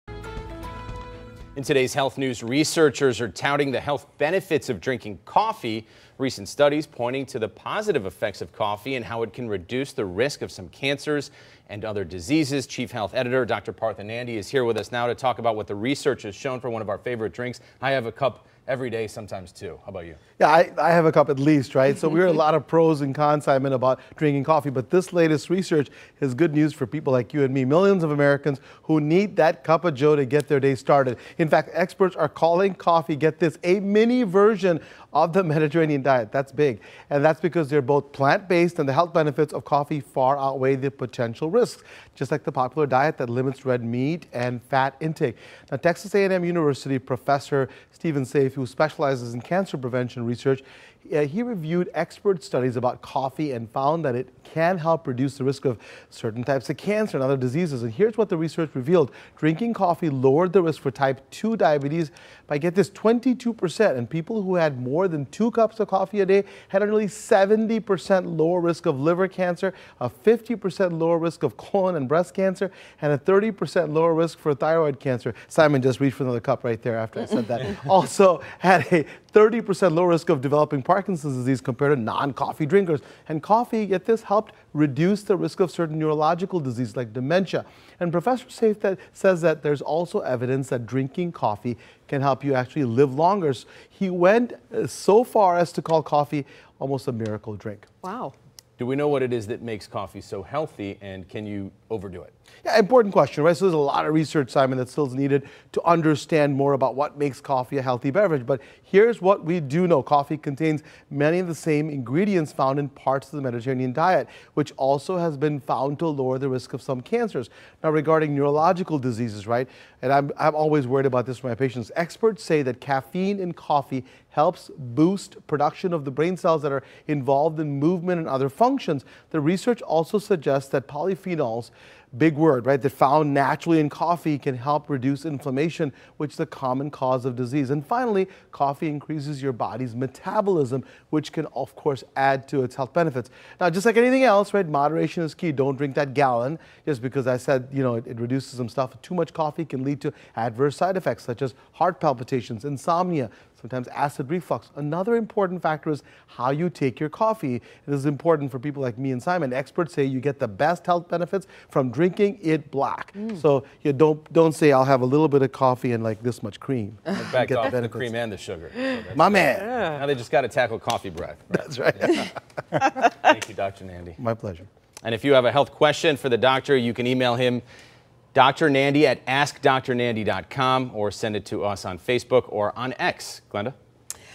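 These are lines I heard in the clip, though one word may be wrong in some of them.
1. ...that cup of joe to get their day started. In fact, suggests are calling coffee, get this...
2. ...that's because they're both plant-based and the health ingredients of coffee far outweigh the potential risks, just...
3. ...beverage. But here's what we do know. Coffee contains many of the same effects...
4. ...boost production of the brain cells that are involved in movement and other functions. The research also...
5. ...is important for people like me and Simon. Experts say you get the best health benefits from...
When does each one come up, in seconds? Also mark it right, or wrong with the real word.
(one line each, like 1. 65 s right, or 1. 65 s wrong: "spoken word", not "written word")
1. 29 s wrong: "experts", not "suggests"
2. 37 s wrong: "benefits", not "ingredients"
3. 108 s wrong: "ingredients", not "effects"
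4. 124 s right
5. 157 s right.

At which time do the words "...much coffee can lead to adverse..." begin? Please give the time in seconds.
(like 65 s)
149 s.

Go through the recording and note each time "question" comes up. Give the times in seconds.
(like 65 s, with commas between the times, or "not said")
103 s, 175 s.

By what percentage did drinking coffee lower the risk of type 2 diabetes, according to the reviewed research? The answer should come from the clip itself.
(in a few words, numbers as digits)
22%.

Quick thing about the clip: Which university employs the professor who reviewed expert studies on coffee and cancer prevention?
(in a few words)
Texas A&M University.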